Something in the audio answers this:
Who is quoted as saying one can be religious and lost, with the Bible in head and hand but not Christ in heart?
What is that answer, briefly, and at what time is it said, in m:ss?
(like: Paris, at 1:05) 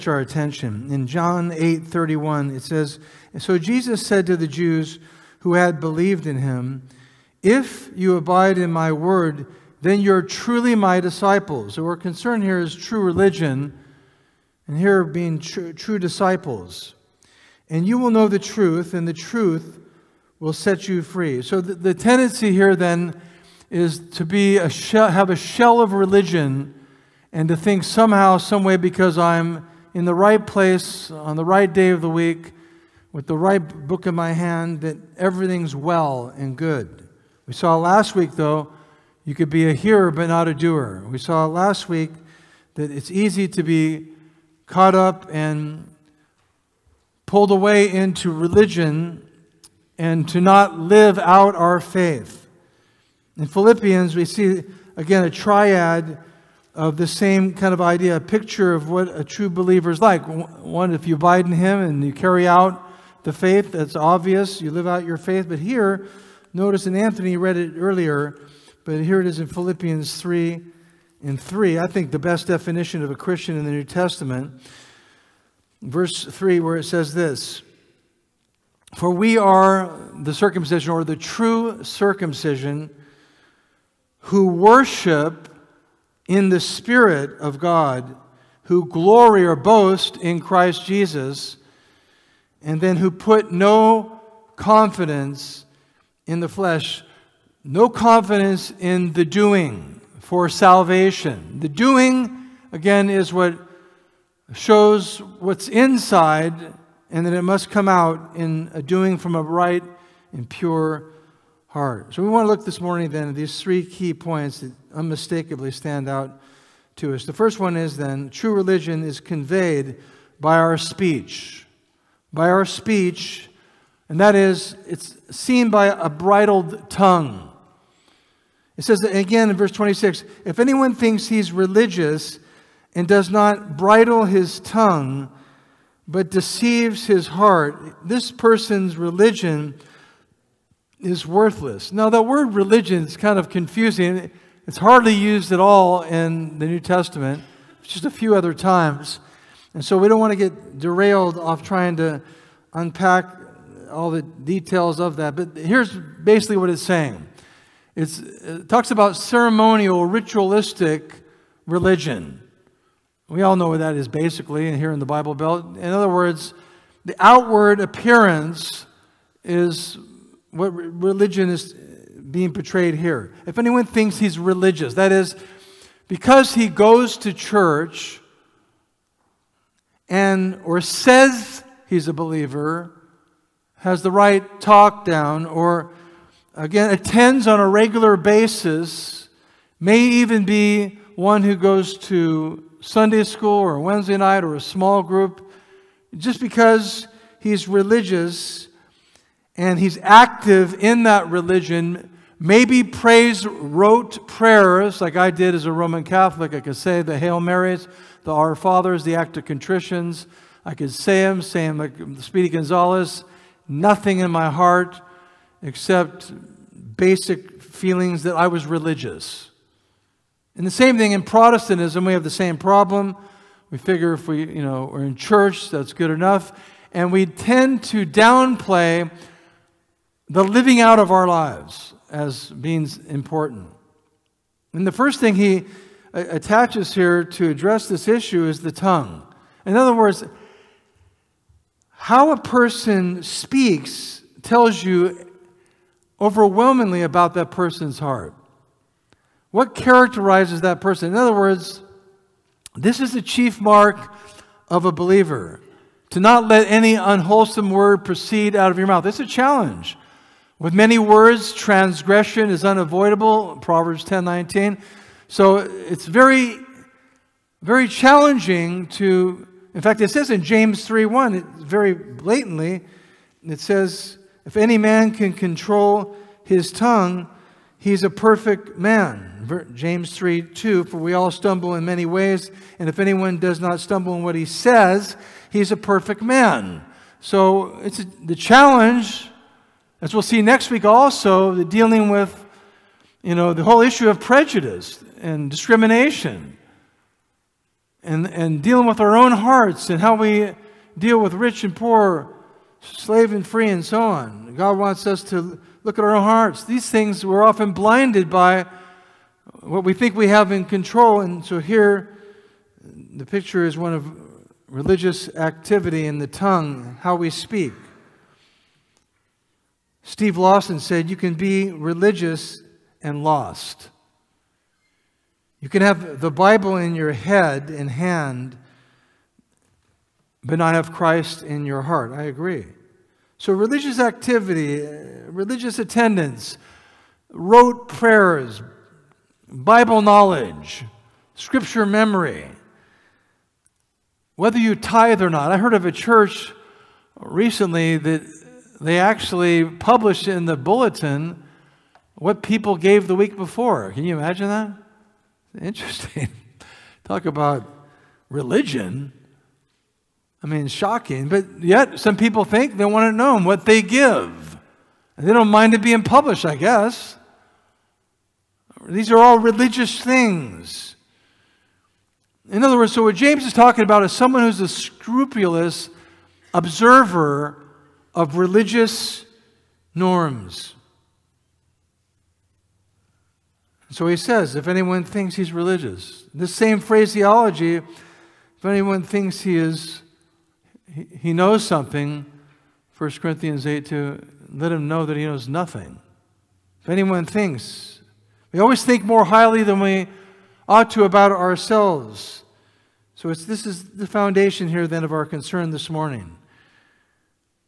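Steve Lawson, at 5:20.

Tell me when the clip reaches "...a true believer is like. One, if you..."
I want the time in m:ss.
0:59.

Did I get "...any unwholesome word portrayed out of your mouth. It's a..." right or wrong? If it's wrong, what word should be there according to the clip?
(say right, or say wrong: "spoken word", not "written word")
wrong: "proceed", not "portrayed".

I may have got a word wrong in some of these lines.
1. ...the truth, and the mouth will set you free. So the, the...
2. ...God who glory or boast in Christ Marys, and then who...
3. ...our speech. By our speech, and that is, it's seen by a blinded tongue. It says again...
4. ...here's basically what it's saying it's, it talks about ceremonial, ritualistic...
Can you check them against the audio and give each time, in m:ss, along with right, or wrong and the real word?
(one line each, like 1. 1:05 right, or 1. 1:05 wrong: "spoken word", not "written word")
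1. 0:18 wrong: "truth", not "mouth"
2. 1:27 wrong: "Jesus", not "Marys"
3. 2:00 wrong: "bridled", not "blinded"
4. 2:35 right.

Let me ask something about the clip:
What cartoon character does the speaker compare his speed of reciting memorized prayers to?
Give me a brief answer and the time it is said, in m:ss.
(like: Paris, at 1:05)
Speedy Gonzalez, at 3:32.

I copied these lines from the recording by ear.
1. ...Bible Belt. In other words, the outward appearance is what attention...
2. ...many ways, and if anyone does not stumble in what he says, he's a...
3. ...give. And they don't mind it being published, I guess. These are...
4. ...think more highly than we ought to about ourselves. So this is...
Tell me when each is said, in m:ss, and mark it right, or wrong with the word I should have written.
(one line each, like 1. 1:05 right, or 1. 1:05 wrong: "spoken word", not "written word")
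1. 2:45 wrong: "religion", not "attention"
2. 4:41 right
3. 6:03 right
4. 6:38 right.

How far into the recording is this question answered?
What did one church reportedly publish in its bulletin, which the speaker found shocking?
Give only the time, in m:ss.
5:52.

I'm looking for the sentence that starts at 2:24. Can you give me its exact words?
It's hardly used at all in the New Testament, just a few other times.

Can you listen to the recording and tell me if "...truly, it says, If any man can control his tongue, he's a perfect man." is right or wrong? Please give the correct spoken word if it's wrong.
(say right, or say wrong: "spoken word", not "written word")
wrong: "blatantly", not "truly".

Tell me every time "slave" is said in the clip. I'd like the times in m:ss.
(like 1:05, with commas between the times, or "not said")
5:02.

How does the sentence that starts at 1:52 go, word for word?
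So we want to look this morning then at these three key points that unmistakably stand out to us.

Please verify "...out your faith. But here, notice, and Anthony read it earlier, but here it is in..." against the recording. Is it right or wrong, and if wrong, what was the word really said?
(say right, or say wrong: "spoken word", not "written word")
right.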